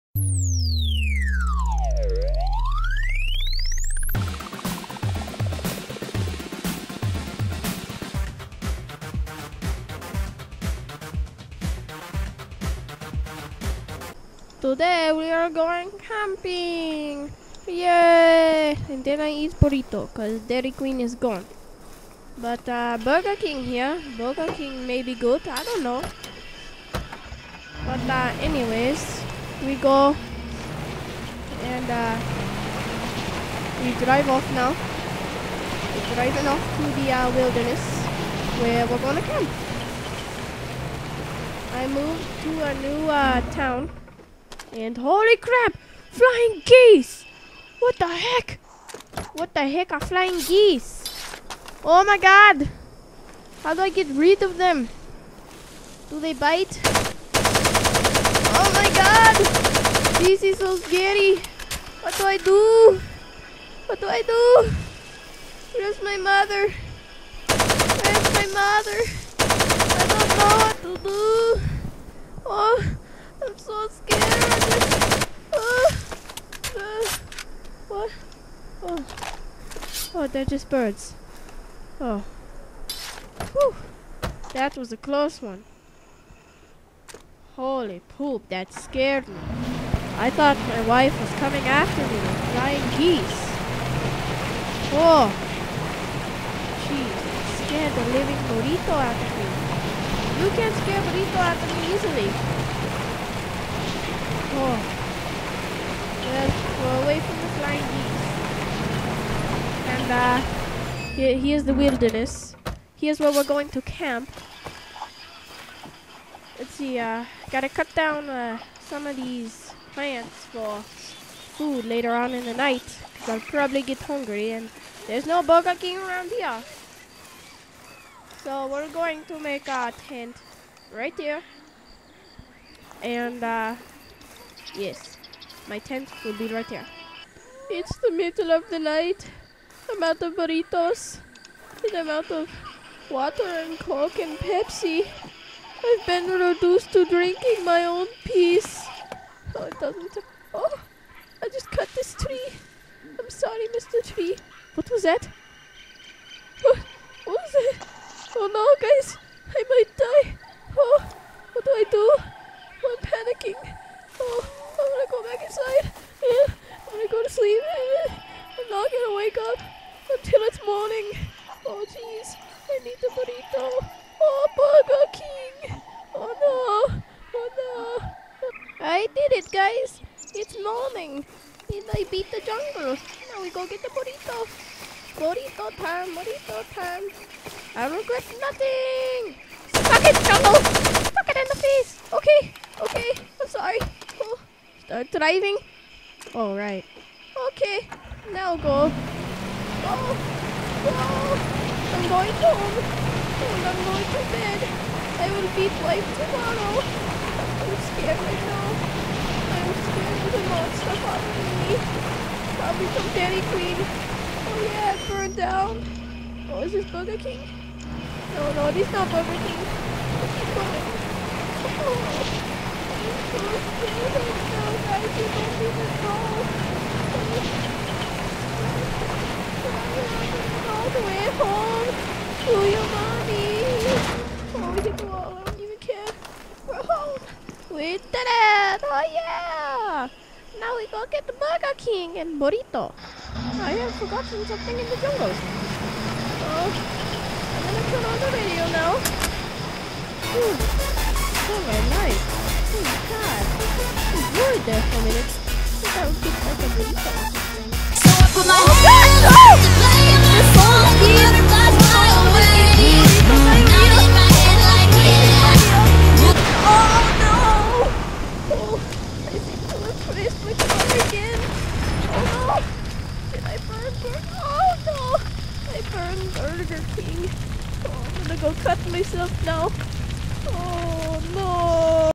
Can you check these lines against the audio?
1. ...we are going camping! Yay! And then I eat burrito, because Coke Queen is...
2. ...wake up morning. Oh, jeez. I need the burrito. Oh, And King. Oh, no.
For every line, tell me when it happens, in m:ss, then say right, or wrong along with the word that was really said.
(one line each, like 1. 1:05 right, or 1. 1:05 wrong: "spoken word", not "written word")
1. 0:15 wrong: "Dairy", not "Coke"
2. 2:49 wrong: "Burger", not "And".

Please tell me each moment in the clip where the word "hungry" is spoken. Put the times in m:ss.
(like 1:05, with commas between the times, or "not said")
2:03.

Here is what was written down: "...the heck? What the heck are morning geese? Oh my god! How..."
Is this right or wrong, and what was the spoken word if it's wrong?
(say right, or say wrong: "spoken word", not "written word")
wrong: "flying", not "morning".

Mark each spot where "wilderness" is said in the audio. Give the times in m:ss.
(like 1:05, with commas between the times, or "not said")
0:37, 1:51.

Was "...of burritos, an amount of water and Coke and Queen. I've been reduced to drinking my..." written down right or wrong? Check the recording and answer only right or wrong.
wrong.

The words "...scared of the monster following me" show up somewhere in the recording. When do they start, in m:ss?
3:29.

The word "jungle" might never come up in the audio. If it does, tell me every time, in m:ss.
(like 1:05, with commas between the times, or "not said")
3:02, 3:10, 4:04.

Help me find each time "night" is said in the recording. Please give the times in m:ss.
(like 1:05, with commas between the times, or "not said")
2:02, 2:18.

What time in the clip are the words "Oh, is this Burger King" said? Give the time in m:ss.
3:36.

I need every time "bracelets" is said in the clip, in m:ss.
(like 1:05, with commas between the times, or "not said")
not said.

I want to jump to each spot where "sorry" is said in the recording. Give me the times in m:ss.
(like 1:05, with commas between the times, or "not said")
2:33, 3:13.